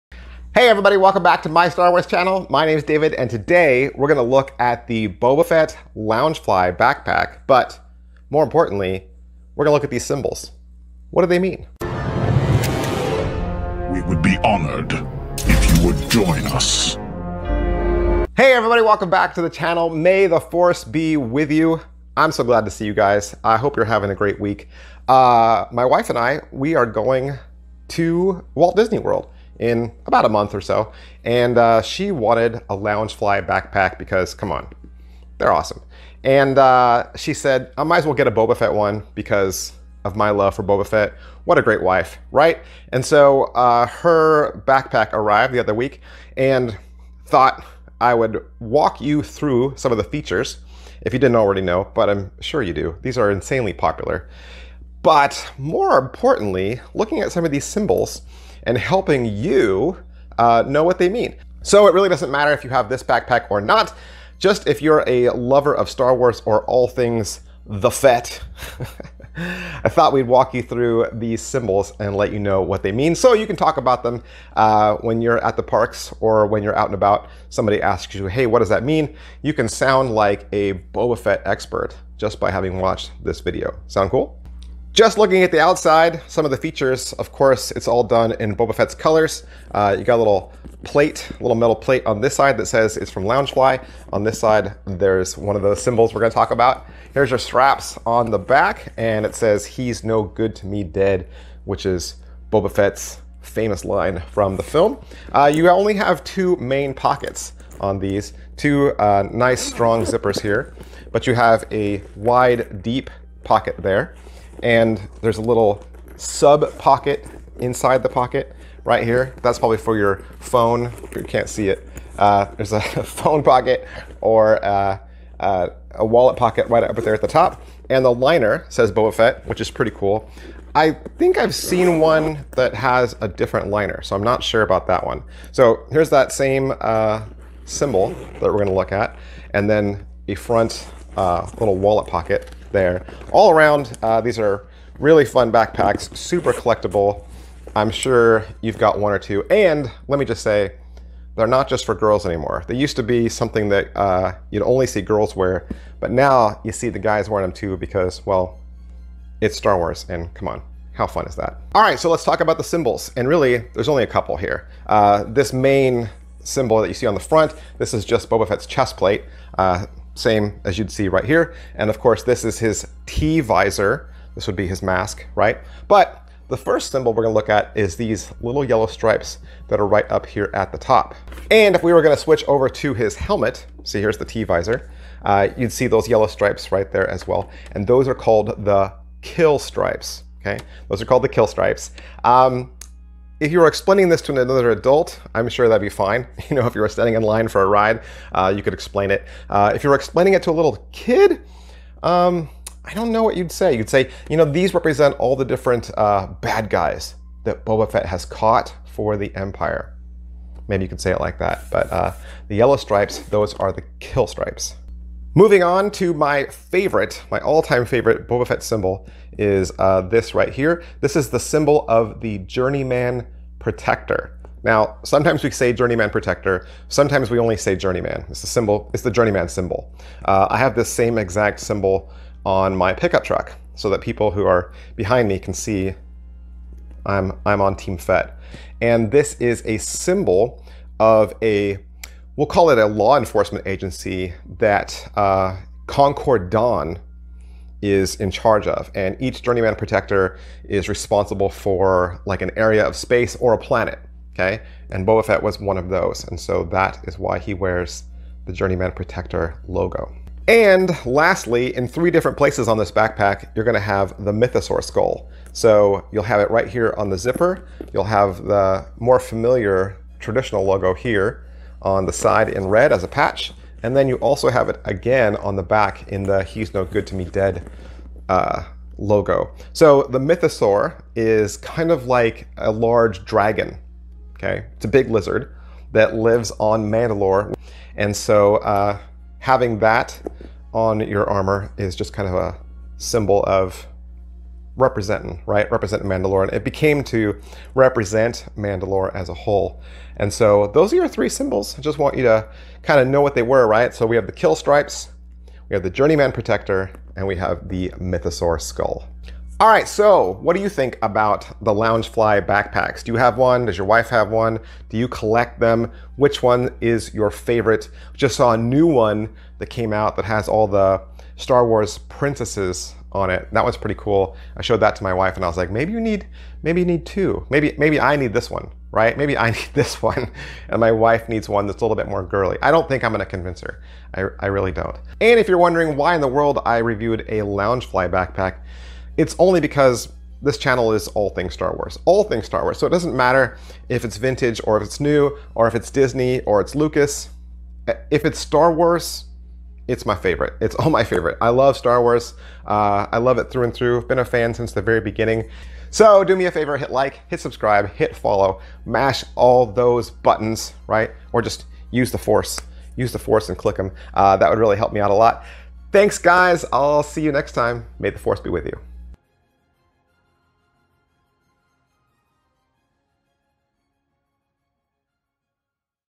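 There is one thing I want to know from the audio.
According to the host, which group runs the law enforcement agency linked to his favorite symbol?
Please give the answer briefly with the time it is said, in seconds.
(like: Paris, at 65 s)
Concord Dawn, at 245 s.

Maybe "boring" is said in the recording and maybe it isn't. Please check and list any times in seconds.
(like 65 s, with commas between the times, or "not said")
not said.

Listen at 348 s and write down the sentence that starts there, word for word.
If it's Star Wars, it's my favorite.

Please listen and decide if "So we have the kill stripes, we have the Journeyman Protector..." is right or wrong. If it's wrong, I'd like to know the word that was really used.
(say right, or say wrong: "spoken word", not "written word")
right.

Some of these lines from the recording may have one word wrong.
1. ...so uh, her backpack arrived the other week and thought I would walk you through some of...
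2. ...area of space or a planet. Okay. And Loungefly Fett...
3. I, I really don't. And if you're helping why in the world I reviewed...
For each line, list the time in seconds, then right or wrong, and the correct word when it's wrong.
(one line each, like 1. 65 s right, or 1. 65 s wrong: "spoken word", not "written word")
1. 43 s right
2. 252 s wrong: "Boba", not "Loungefly"
3. 334 s wrong: "wondering", not "helping".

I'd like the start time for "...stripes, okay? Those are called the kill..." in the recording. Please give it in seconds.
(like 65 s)
189 s.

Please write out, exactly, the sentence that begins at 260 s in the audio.
And lastly, in three different places on this backpack, you're gonna have the Mythosaur skull.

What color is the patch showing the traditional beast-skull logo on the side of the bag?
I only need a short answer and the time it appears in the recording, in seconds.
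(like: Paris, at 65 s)
Red, at 272 s.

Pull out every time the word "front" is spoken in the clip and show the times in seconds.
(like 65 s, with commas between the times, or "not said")
140 s, 167 s.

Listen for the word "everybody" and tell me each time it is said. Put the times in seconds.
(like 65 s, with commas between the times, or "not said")
0 s, 18 s.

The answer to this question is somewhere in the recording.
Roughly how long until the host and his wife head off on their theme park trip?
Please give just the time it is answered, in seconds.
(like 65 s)
30 s.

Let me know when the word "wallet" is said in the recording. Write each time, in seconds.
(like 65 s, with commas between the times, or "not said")
126 s, 141 s.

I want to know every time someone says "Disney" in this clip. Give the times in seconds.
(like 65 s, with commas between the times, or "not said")
28 s, 345 s.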